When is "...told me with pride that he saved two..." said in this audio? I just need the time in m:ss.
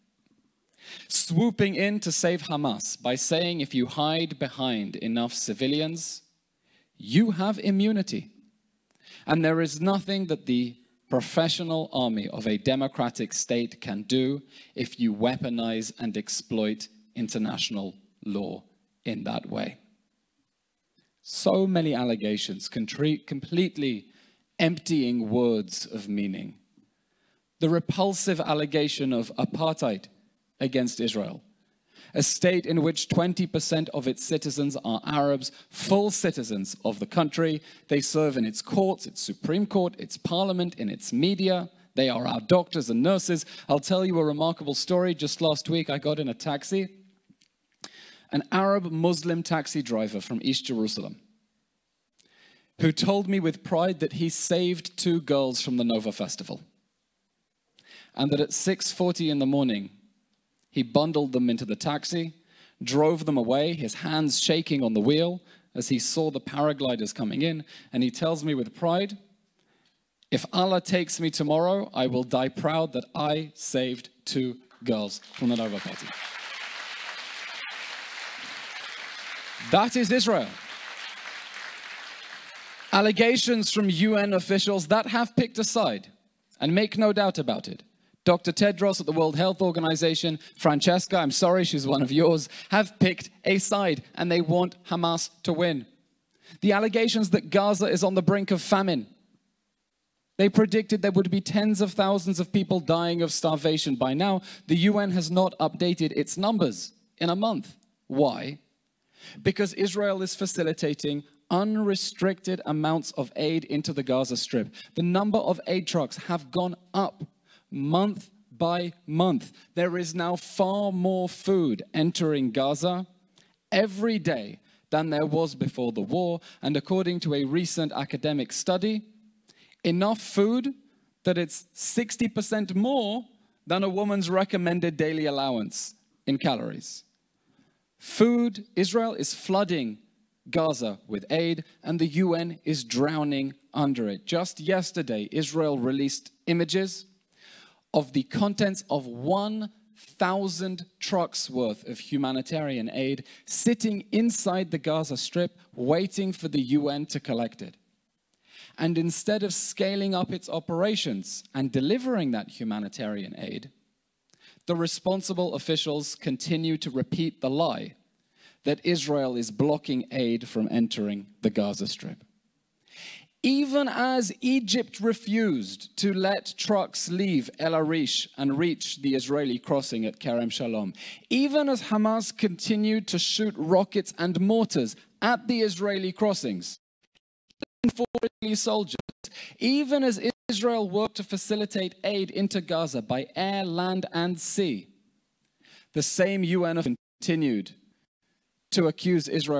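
0:52.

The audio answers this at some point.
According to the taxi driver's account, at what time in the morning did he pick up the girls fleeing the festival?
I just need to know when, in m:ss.
0:58.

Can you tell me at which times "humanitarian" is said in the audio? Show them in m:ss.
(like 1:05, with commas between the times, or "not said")
2:31, 2:42.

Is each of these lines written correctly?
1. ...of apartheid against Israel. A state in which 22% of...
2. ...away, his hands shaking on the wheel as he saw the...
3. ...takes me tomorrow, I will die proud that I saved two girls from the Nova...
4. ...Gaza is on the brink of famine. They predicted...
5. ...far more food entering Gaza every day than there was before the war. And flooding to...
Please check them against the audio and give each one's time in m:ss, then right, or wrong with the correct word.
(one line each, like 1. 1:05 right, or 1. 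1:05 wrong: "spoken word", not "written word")
1. 0:29 wrong: "20", not "22"
2. 1:03 right
3. 1:10 right
4. 1:37 right
5. 2:00 wrong: "according", not "flooding".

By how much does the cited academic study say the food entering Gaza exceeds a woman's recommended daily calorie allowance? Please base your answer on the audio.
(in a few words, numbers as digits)
60%.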